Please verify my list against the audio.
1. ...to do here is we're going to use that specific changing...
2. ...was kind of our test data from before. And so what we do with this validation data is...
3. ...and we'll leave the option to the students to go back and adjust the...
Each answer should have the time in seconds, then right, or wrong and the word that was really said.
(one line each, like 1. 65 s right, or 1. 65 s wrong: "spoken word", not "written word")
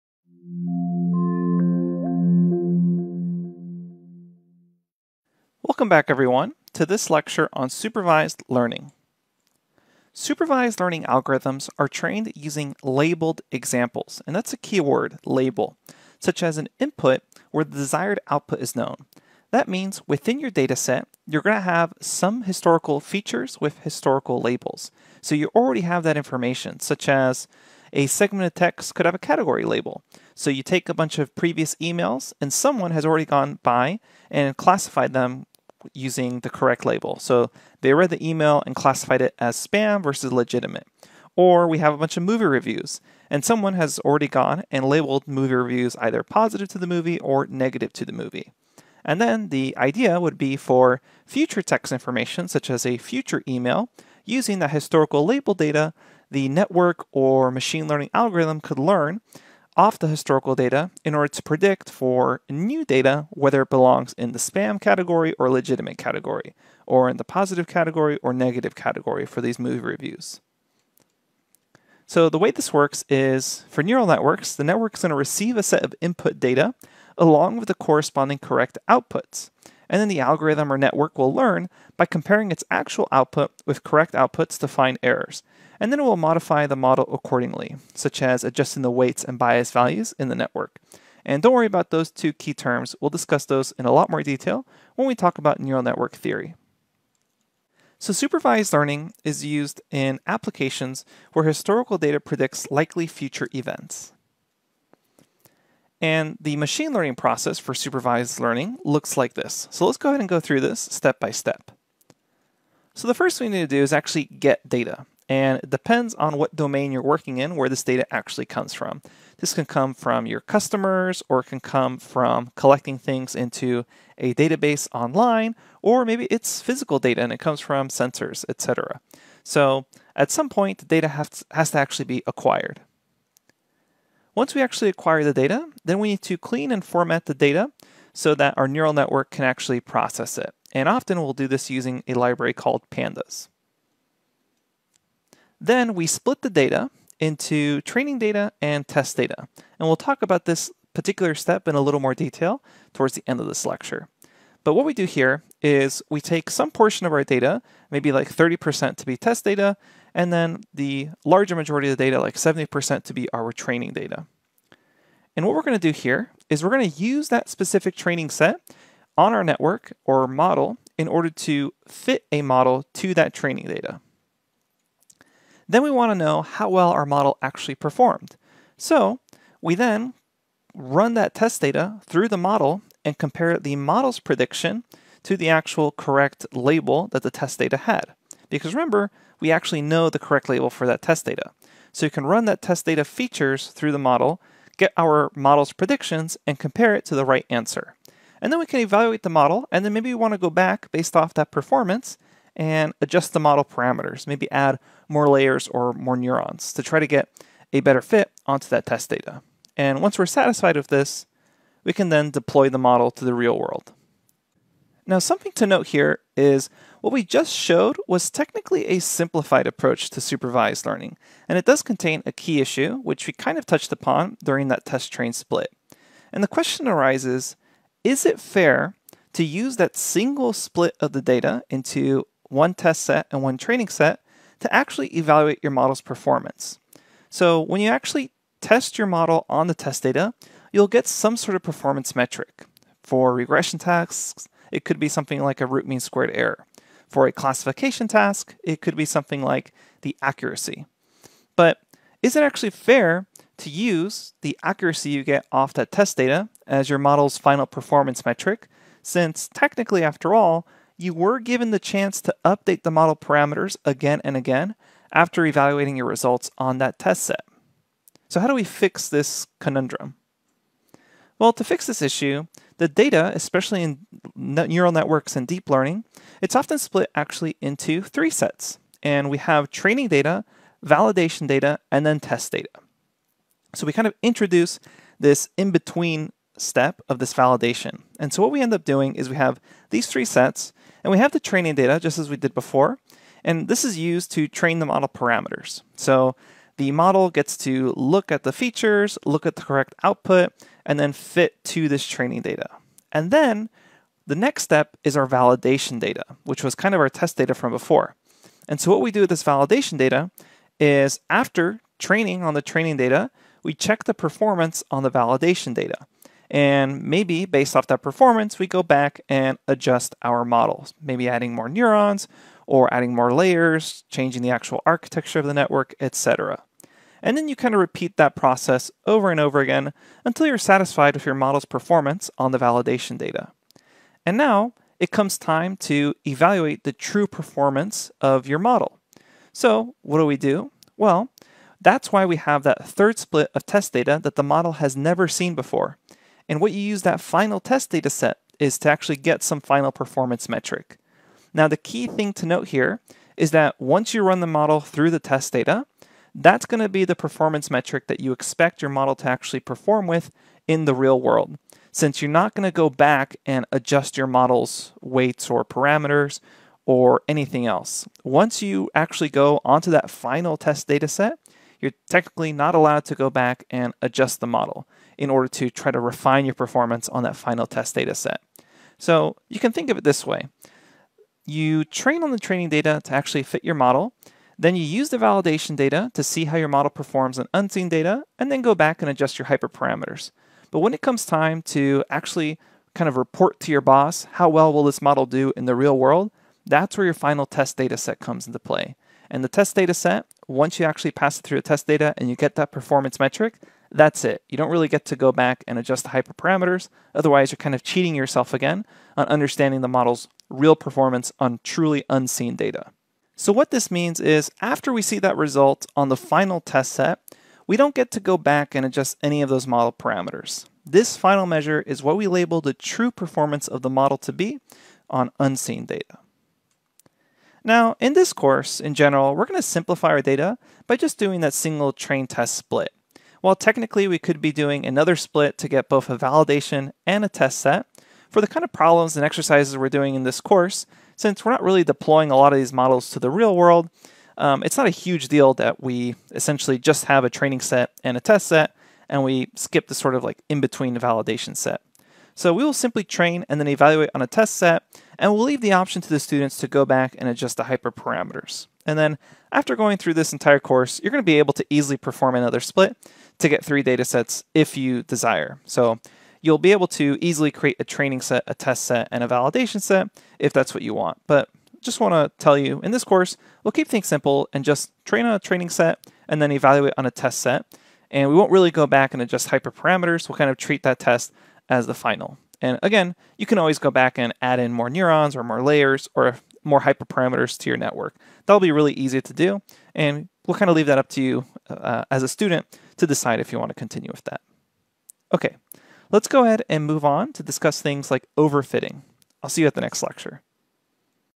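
1. 165 s wrong: "training", not "changing"
2. 306 s right
3. 455 s right.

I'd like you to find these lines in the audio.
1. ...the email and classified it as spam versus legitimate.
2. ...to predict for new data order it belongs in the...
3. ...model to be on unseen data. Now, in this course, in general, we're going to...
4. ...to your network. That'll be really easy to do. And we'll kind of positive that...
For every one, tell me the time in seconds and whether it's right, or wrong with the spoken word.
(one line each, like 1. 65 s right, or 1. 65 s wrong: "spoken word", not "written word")
1. 38 s right
2. 61 s wrong: "whether", not "order"
3. 423 s right
4. 487 s wrong: "leave", not "positive".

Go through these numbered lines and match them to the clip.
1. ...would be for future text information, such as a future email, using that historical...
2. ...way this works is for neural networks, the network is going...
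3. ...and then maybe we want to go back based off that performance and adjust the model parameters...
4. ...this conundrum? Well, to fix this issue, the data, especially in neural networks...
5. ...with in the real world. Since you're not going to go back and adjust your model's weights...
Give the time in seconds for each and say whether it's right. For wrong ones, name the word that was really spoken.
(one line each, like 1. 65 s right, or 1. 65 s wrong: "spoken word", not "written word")
1. 50 s right
2. 72 s right
3. 199 s right
4. 269 s right
5. 360 s right.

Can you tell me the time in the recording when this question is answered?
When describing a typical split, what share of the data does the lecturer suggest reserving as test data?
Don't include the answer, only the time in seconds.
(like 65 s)
158 s.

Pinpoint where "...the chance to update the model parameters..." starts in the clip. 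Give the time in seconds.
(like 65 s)
261 s.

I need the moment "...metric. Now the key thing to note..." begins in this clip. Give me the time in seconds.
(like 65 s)
350 s.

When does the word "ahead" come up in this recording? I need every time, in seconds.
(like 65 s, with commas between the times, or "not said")
110 s, 496 s.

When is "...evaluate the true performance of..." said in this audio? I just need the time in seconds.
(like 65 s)
336 s.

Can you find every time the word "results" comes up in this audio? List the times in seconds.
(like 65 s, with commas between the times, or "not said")
266 s, 415 s.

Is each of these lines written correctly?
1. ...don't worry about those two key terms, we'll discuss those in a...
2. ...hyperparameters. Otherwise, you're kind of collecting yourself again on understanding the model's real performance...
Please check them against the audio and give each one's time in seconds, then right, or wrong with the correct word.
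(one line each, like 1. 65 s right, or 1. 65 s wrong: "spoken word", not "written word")
1. 91 s right
2. 406 s wrong: "cheating", not "collecting".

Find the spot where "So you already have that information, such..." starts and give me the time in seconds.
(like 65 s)
25 s.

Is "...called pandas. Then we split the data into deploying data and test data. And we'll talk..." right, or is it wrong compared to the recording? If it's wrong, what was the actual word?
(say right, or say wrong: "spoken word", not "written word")
wrong: "training", not "deploying".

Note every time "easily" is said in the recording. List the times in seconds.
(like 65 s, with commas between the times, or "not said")
461 s, 467 s.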